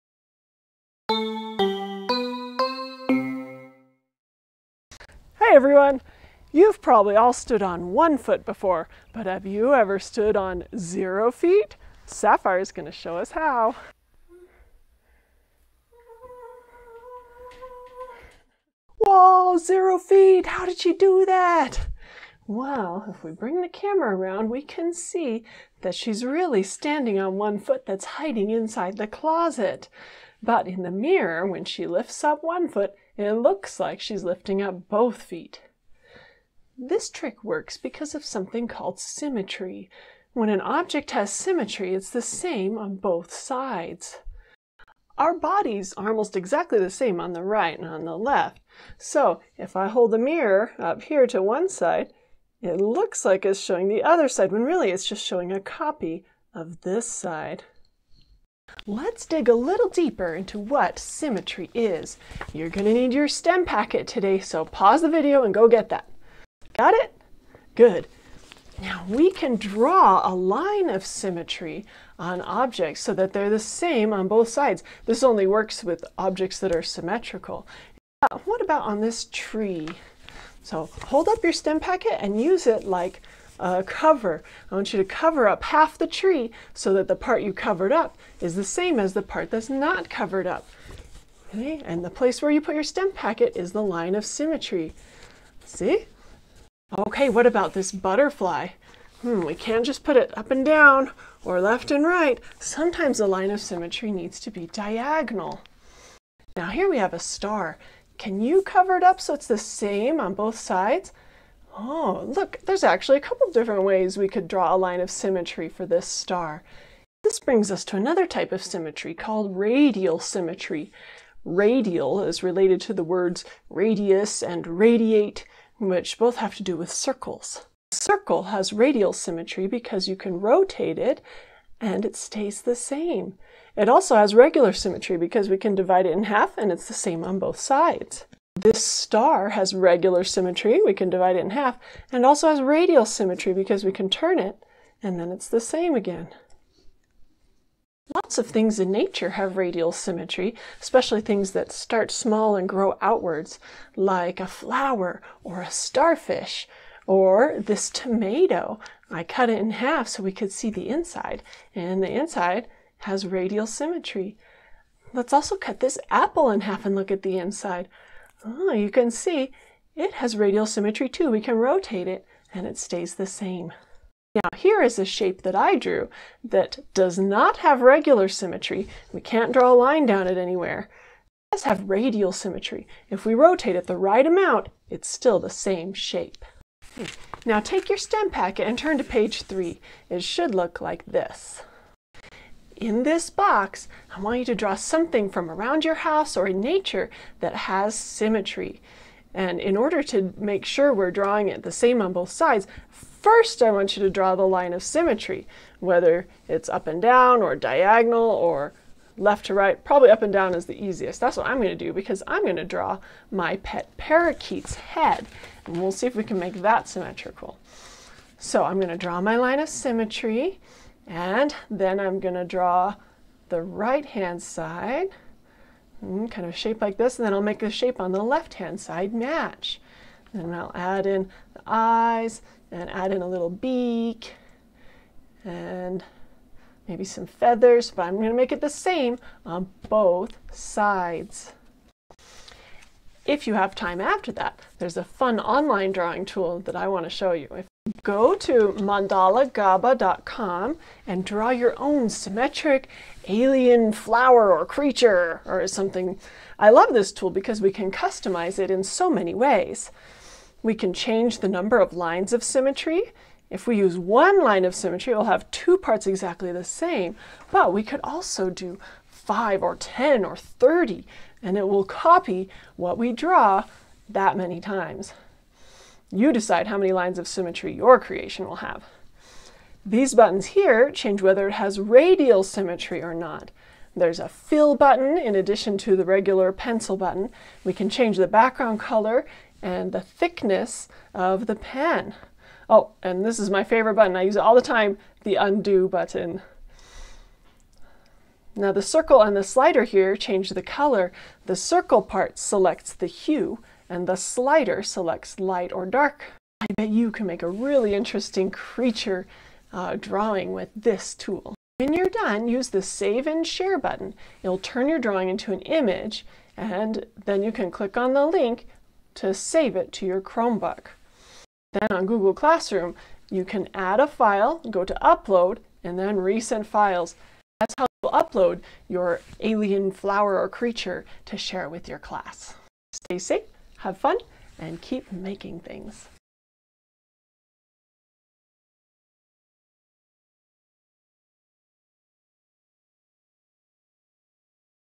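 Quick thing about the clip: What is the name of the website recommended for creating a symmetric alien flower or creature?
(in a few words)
mandalagaba.com.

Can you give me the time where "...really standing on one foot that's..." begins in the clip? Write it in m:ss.
0:26.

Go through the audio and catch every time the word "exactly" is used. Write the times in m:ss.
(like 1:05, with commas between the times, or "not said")
0:46, 4:26.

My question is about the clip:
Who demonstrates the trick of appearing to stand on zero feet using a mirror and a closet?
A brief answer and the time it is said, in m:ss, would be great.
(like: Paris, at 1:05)
Sapphire, at 0:12.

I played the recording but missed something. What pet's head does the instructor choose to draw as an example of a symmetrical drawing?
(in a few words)
Parakeet.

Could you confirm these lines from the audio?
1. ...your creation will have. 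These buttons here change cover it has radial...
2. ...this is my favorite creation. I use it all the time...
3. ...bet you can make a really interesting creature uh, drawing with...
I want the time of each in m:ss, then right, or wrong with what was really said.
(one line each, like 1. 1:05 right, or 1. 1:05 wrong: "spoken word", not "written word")
1. 4:37 wrong: "whether", not "cover"
2. 4:53 wrong: "button", not "creation"
3. 5:06 right.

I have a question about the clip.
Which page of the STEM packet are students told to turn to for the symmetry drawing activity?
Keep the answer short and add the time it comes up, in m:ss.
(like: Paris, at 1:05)
3, at 3:09.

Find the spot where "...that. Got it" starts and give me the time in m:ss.
1:05.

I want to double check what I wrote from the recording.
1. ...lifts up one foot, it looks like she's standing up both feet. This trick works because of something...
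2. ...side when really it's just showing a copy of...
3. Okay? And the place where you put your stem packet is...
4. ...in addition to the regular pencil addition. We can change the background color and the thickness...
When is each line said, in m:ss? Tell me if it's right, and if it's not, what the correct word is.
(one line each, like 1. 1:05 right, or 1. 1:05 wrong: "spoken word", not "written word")
1. 0:31 wrong: "lifting", not "standing"
2. 0:54 right
3. 1:31 right
4. 4:45 wrong: "button", not "addition".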